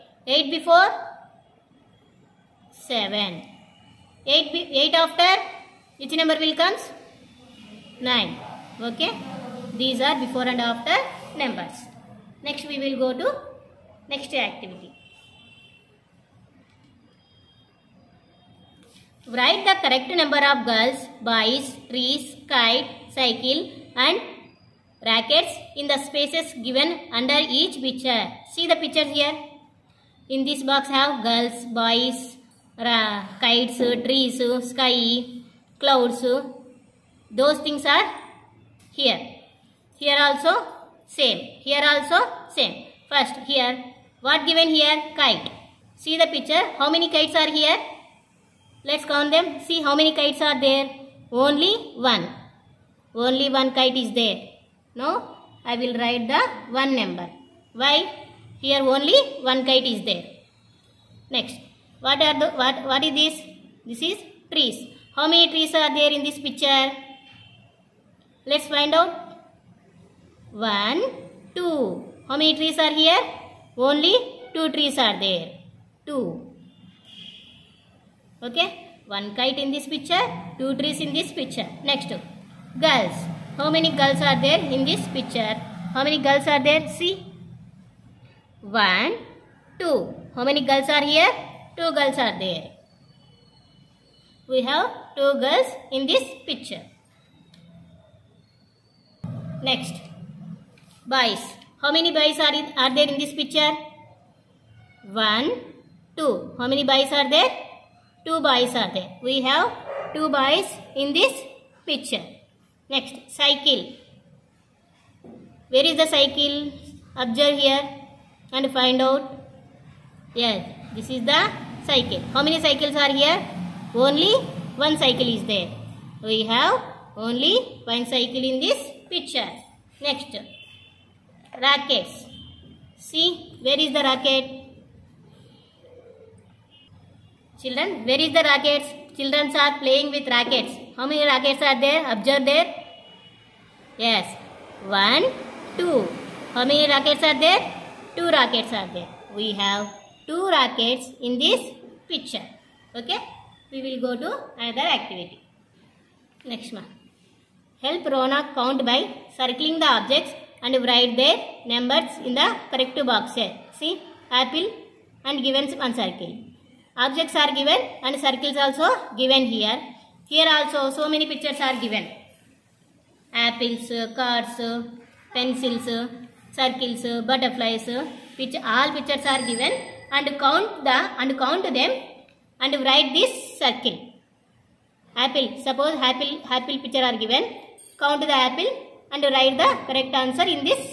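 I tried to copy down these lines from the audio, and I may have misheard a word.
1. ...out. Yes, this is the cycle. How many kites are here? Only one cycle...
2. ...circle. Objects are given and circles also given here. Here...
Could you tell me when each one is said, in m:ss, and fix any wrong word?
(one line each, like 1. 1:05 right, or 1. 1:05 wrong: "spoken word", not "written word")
1. 1:59 wrong: "cycles", not "kites"
2. 2:45 right.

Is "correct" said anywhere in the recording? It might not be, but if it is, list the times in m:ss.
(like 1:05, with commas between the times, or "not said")
0:19, 2:42, 3:09.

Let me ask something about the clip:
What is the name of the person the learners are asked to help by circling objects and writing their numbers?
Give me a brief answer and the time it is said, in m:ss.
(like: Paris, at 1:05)
Rona, at 2:38.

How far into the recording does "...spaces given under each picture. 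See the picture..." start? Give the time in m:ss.
0:26.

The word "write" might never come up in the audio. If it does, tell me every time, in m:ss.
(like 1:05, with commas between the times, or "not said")
0:19, 0:56, 2:40, 3:02, 3:09.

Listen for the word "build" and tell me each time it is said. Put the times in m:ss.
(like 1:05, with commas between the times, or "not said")
not said.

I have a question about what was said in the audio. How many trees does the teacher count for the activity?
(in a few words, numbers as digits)
2.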